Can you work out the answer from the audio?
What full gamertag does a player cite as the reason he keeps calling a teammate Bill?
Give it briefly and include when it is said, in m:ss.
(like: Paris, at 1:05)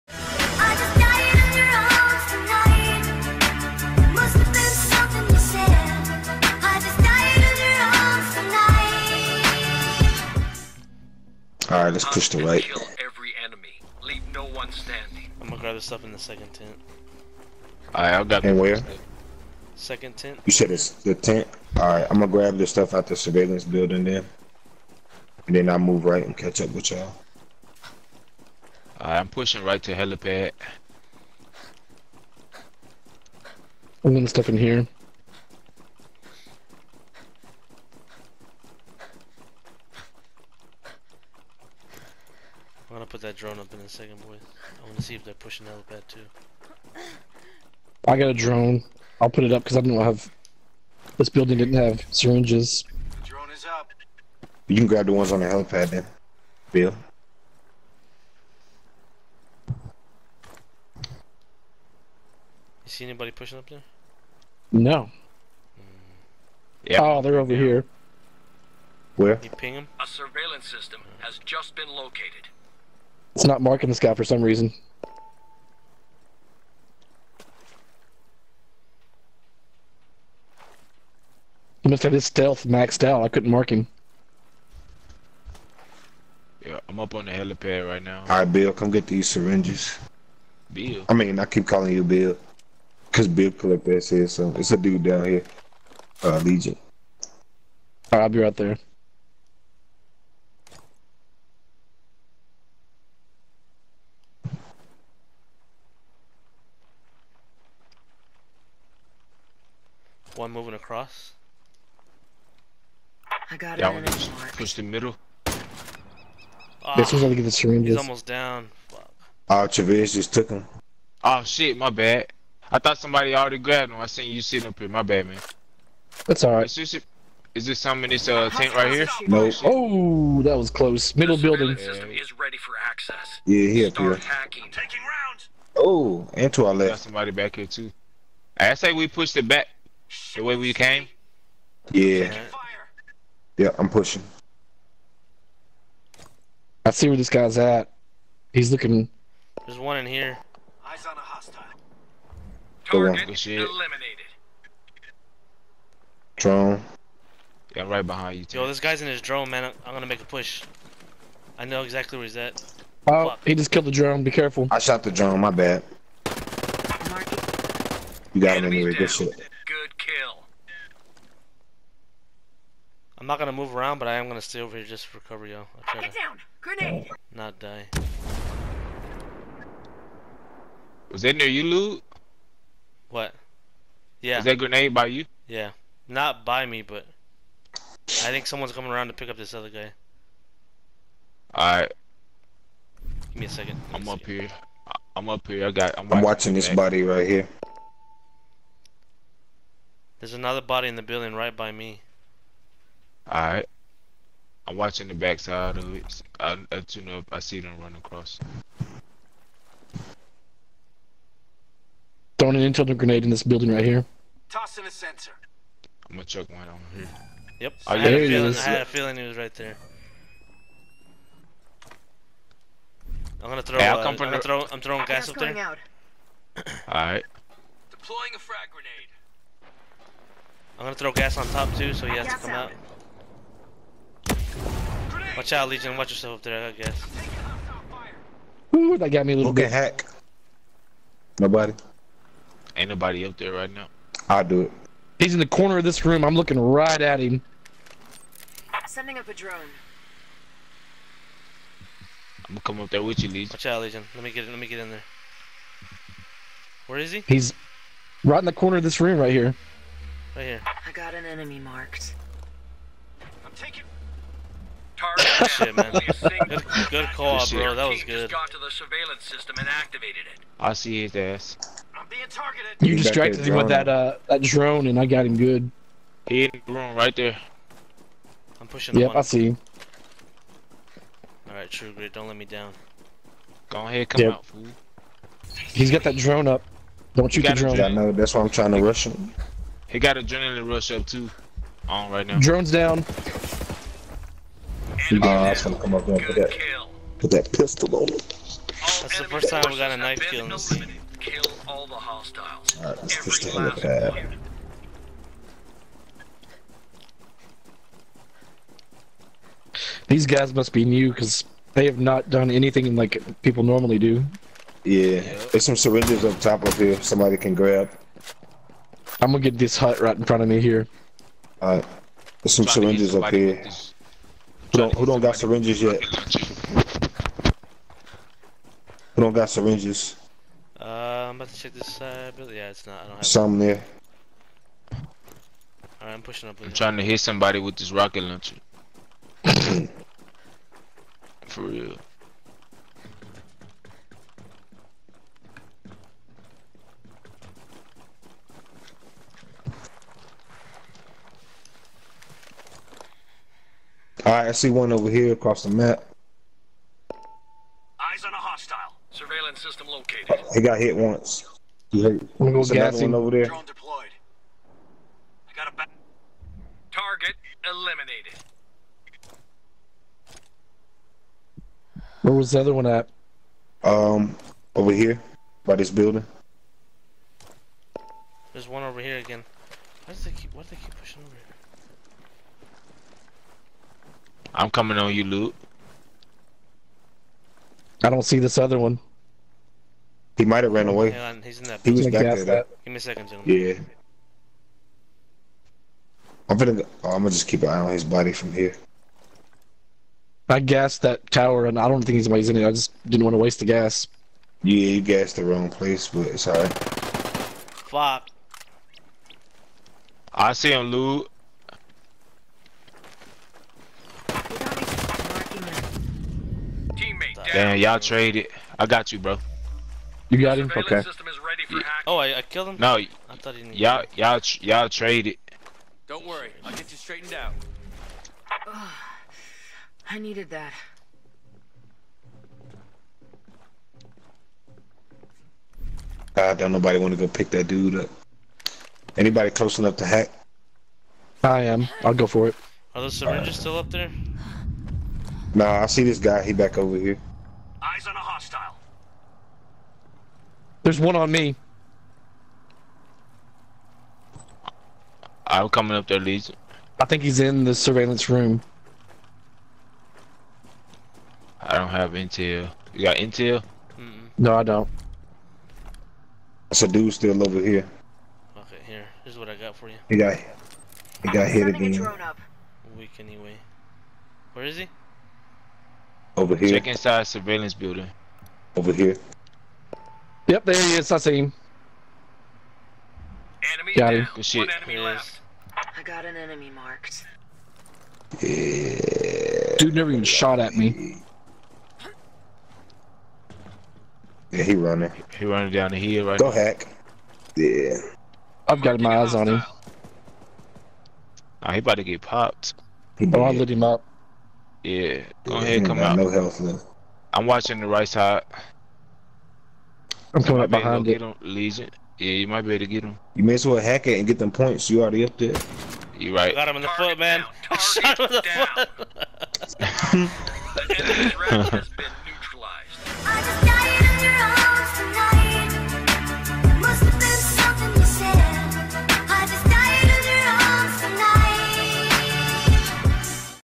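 Bill Collector, at 1:33.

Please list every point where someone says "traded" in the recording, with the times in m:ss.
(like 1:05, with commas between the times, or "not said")
6:57, 7:04.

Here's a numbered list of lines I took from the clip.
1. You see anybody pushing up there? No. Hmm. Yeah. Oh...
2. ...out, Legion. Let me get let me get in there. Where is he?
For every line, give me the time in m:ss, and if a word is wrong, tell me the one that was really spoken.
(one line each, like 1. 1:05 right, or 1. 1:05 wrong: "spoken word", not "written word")
1. 0:59 right
2. 4:13 right.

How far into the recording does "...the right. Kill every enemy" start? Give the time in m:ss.
0:12.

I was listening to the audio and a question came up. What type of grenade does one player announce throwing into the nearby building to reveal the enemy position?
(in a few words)
Intel grenade.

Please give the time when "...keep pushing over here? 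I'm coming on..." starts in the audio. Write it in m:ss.
6:20.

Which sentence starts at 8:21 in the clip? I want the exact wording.
Oh, he about to get popped.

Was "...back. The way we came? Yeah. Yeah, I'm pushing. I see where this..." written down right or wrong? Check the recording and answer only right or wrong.
right.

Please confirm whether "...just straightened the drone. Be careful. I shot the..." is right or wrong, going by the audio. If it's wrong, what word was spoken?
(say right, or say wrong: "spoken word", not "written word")
wrong: "killed", not "straightened".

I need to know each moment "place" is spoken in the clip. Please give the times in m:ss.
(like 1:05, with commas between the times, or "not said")
6:45.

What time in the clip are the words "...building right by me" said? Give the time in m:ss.
3:21.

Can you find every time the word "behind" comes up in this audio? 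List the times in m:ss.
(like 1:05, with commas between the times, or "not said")
2:38, 8:30.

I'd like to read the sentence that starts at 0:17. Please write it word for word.
Alright, i I've got And where?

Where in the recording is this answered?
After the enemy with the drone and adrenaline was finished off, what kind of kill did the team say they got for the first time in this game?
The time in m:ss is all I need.
4:59.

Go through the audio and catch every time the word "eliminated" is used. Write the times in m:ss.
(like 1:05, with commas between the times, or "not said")
2:33, 6:07.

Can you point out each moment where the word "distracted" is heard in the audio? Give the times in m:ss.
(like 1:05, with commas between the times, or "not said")
4:32.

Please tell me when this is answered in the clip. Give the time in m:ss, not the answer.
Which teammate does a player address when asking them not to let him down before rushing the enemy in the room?
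4:41.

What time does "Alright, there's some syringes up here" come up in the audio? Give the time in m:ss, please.
5:21.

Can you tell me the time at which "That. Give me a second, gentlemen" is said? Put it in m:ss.
6:32.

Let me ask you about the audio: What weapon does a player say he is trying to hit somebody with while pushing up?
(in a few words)
Rocket launcher.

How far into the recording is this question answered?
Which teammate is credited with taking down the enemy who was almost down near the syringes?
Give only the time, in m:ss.
1:59.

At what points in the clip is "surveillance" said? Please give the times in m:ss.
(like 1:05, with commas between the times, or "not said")
0:23, 1:10, 4:28, 5:59, 7:37, 7:57.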